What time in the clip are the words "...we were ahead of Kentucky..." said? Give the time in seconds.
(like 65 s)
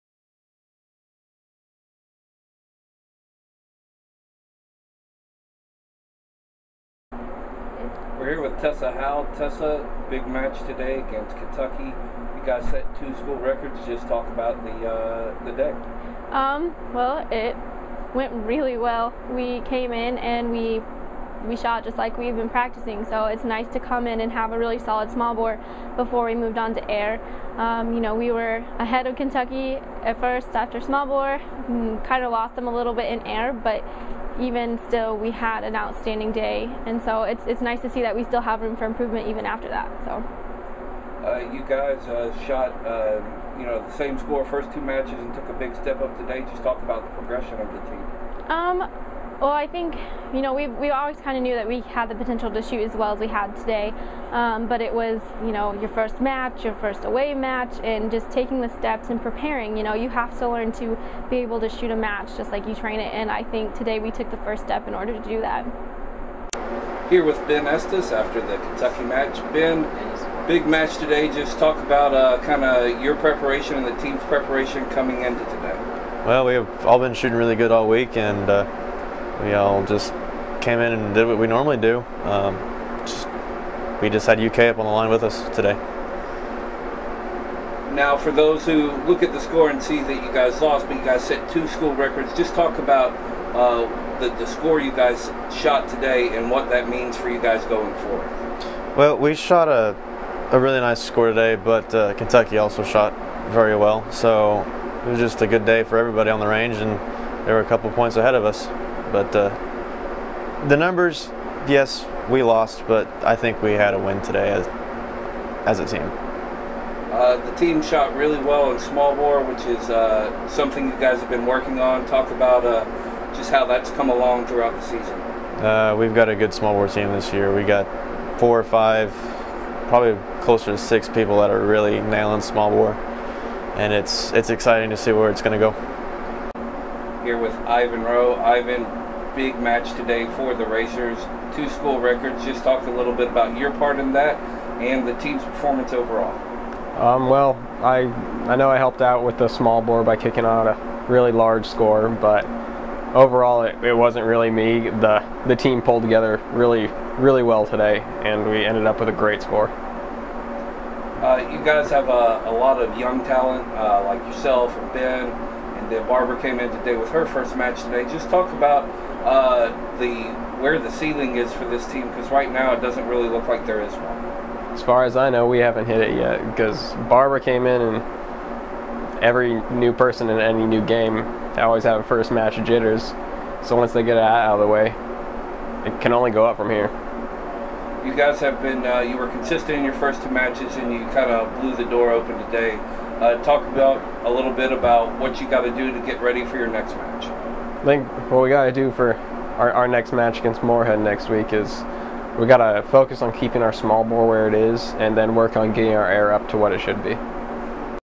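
28 s.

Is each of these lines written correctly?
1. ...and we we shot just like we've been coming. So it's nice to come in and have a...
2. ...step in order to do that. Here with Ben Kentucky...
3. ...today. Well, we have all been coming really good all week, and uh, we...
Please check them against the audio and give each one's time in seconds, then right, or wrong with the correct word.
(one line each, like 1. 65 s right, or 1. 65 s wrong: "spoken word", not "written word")
1. 20 s wrong: "practicing", not "coming"
2. 64 s wrong: "Estes", not "Kentucky"
3. 75 s wrong: "shooting", not "coming".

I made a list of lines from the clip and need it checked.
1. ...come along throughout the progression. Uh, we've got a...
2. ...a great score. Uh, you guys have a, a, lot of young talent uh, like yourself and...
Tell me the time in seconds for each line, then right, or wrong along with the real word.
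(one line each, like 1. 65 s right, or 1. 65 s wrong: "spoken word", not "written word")
1. 123 s wrong: "season", not "progression"
2. 159 s right.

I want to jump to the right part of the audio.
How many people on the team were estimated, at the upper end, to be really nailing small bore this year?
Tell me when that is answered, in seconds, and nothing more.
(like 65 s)
130 s.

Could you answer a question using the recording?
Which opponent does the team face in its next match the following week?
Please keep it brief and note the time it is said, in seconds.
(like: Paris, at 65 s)
Morehead, at 200 s.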